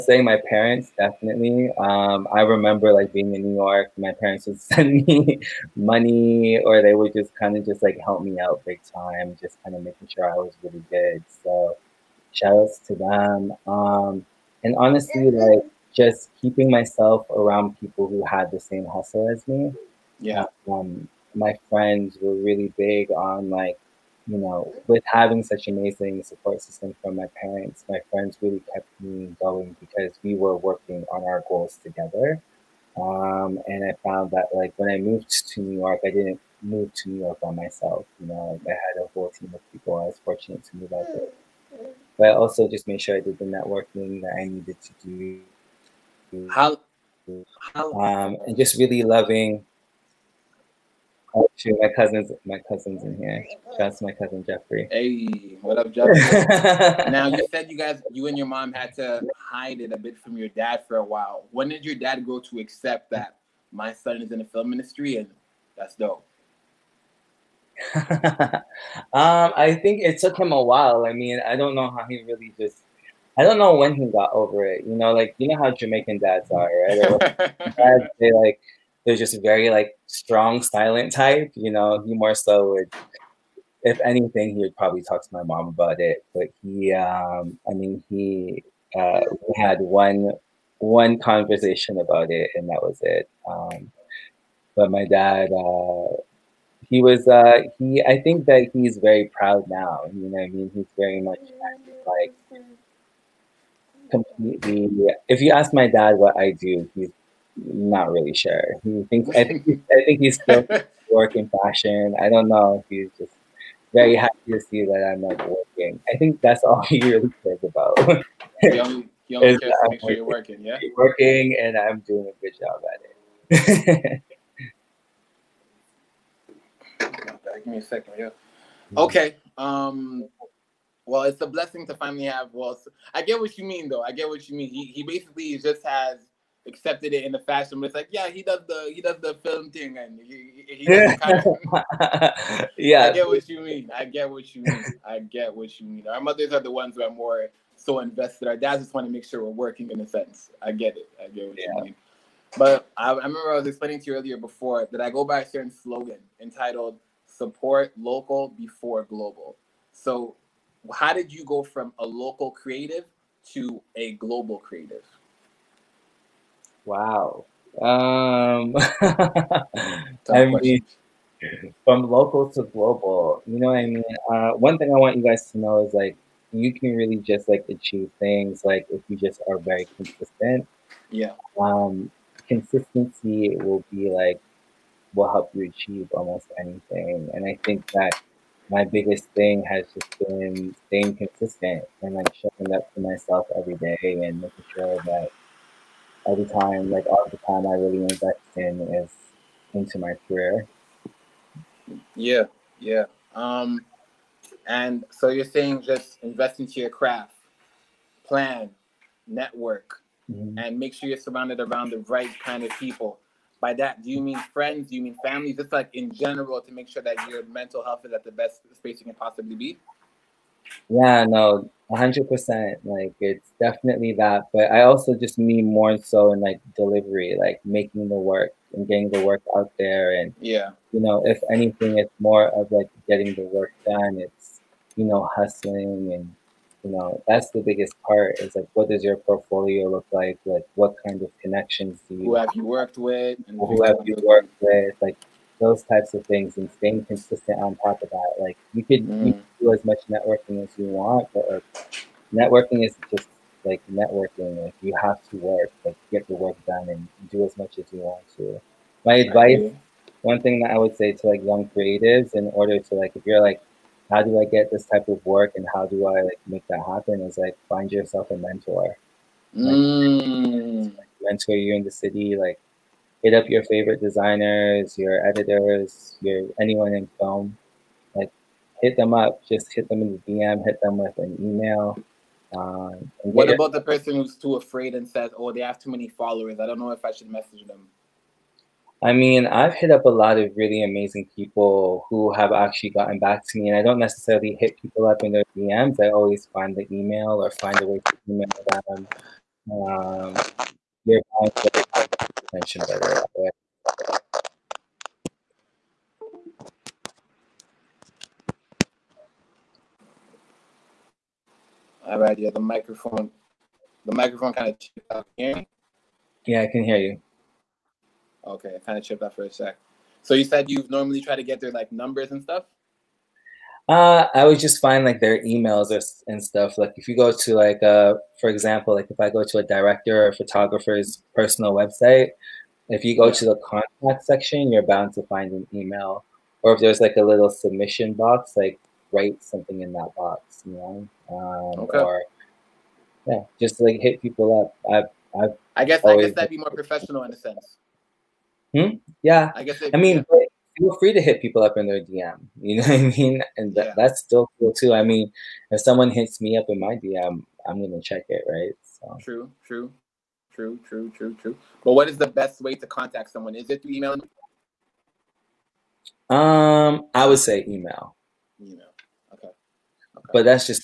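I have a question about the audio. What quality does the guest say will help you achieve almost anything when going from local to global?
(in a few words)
Consistency.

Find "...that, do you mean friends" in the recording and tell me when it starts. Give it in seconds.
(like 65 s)
213 s.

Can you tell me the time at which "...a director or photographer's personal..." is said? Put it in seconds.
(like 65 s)
329 s.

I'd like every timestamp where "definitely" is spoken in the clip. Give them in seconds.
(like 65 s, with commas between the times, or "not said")
0 s, 223 s.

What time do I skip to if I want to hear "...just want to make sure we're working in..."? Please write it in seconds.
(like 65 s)
148 s.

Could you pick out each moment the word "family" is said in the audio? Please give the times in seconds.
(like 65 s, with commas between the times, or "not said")
215 s.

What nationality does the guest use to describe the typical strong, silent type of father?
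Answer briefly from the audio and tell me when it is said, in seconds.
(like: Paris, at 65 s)
Jamaican, at 75 s.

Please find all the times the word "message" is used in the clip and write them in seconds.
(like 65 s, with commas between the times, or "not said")
287 s.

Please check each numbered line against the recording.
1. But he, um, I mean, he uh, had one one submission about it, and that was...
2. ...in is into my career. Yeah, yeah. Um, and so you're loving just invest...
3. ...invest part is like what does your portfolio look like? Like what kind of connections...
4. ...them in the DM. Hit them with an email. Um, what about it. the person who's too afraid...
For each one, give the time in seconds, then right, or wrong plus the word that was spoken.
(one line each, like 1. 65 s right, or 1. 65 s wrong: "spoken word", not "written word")
1. 86 s wrong: "conversation", not "submission"
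2. 198 s wrong: "saying", not "loving"
3. 237 s wrong: "biggest", not "invest"
4. 279 s right.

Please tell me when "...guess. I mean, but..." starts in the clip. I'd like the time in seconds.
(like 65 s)
349 s.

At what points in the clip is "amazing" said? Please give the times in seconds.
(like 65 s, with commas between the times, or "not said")
25 s, 290 s.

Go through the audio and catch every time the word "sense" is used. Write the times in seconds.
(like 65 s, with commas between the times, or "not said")
150 s, 347 s.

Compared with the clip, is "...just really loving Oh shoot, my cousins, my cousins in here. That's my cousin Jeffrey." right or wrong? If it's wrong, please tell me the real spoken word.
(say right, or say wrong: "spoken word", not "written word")
right.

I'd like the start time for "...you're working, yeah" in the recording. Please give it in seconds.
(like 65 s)
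120 s.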